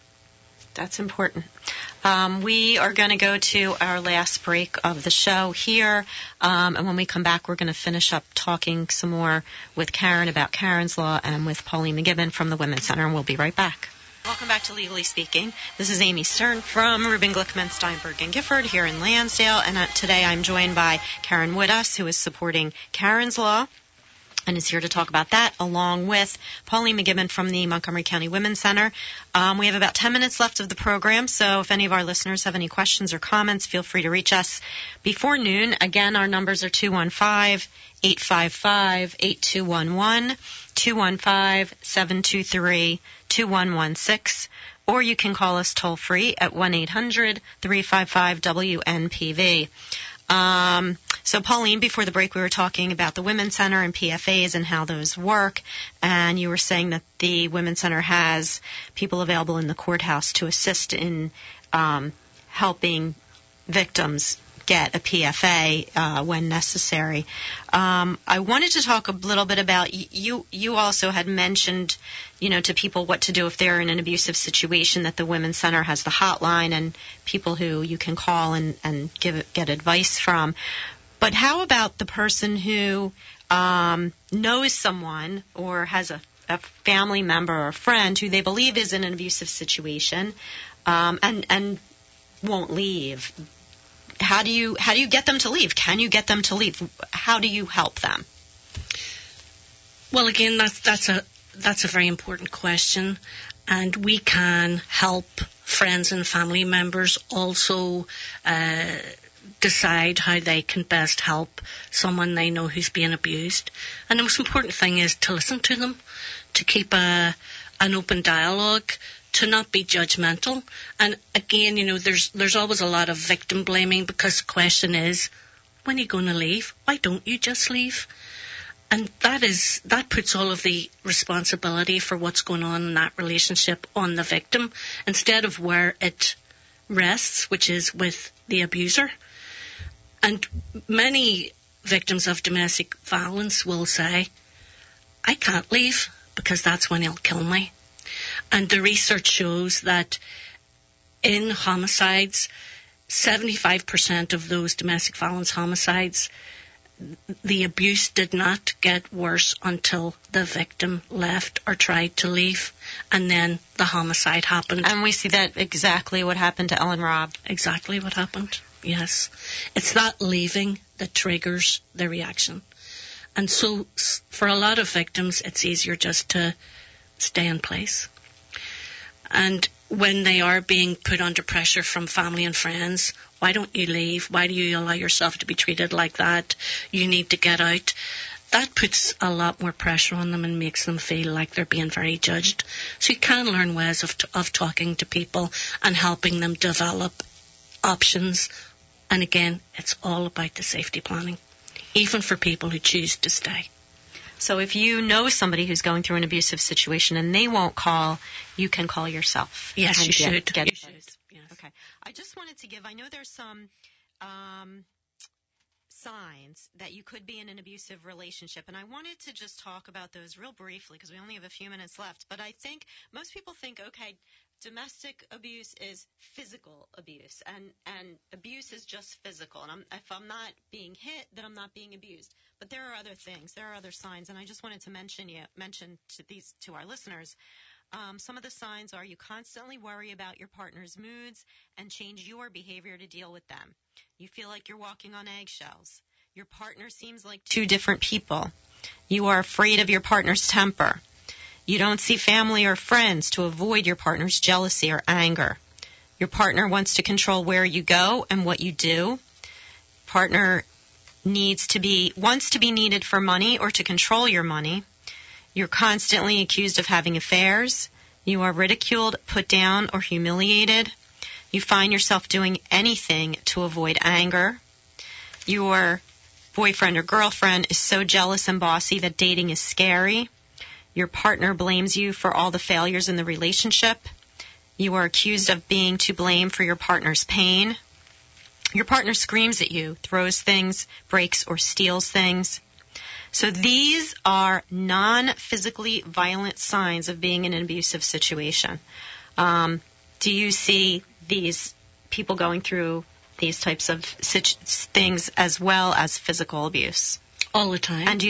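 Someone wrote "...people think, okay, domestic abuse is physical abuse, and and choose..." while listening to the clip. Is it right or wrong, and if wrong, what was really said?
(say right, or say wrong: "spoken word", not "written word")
wrong: "abuse", not "choose".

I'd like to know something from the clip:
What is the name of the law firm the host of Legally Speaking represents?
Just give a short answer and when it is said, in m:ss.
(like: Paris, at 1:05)
Rubin Glickman, Steinberg and Gifford, at 0:17.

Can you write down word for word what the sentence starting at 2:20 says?
And many victims of domestic violence will say, I can't leave because that's when he'll kill me.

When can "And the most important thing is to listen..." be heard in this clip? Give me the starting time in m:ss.
1:54.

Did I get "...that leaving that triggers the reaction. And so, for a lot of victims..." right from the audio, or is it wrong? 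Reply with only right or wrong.
right.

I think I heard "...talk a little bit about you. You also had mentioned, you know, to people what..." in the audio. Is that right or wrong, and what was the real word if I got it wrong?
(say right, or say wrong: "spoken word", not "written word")
right.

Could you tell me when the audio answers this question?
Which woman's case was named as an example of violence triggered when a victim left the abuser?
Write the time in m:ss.
2:46.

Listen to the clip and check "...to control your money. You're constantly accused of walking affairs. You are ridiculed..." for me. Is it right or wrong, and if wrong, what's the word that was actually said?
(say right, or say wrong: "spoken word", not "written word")
wrong: "having", not "walking".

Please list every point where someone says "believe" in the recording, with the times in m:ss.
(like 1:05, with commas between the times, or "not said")
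1:28.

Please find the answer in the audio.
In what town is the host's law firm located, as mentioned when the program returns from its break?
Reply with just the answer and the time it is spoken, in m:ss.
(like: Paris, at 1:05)
Lansdale, at 0:19.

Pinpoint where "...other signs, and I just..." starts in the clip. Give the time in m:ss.
3:53.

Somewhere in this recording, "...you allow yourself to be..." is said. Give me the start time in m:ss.
3:04.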